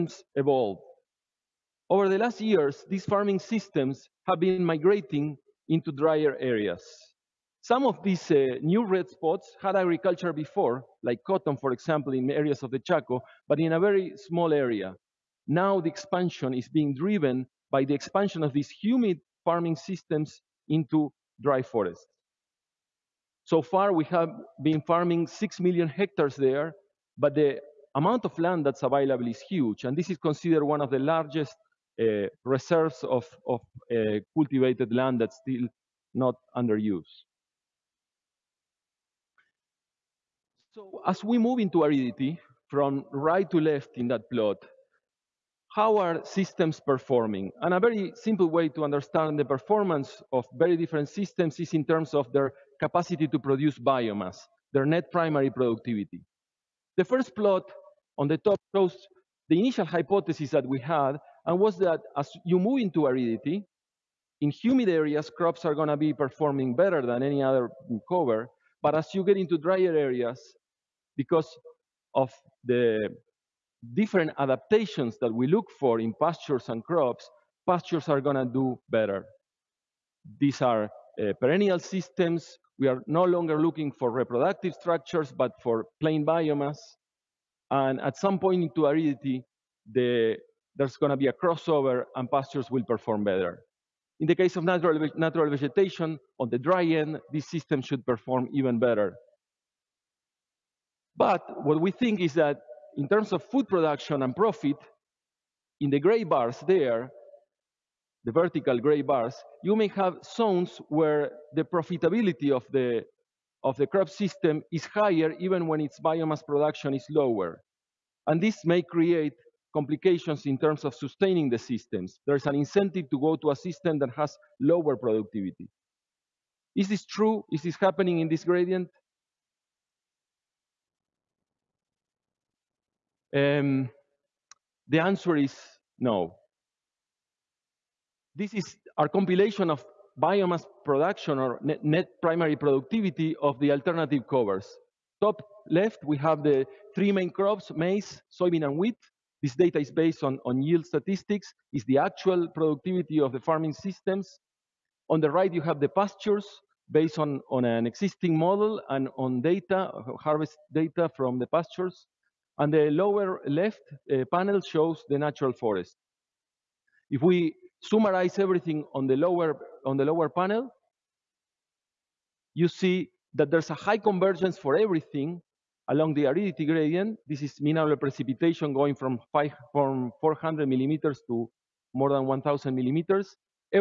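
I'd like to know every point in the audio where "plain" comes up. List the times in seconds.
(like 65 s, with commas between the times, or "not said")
85 s.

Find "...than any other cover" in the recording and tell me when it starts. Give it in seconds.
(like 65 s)
67 s.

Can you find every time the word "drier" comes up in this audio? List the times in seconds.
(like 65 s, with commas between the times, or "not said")
5 s, 69 s.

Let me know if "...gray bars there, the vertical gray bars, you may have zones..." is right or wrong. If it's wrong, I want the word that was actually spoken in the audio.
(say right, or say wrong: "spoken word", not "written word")
right.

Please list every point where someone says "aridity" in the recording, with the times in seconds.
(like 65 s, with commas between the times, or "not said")
41 s, 63 s, 88 s, 176 s.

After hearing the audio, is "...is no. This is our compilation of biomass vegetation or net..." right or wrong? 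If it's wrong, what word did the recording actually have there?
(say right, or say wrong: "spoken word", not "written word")
wrong: "production", not "vegetation".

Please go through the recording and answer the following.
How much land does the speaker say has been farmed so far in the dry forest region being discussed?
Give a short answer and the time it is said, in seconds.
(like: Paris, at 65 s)
6 million hectares, at 25 s.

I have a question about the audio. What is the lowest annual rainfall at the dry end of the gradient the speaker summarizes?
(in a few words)
400 millimeters.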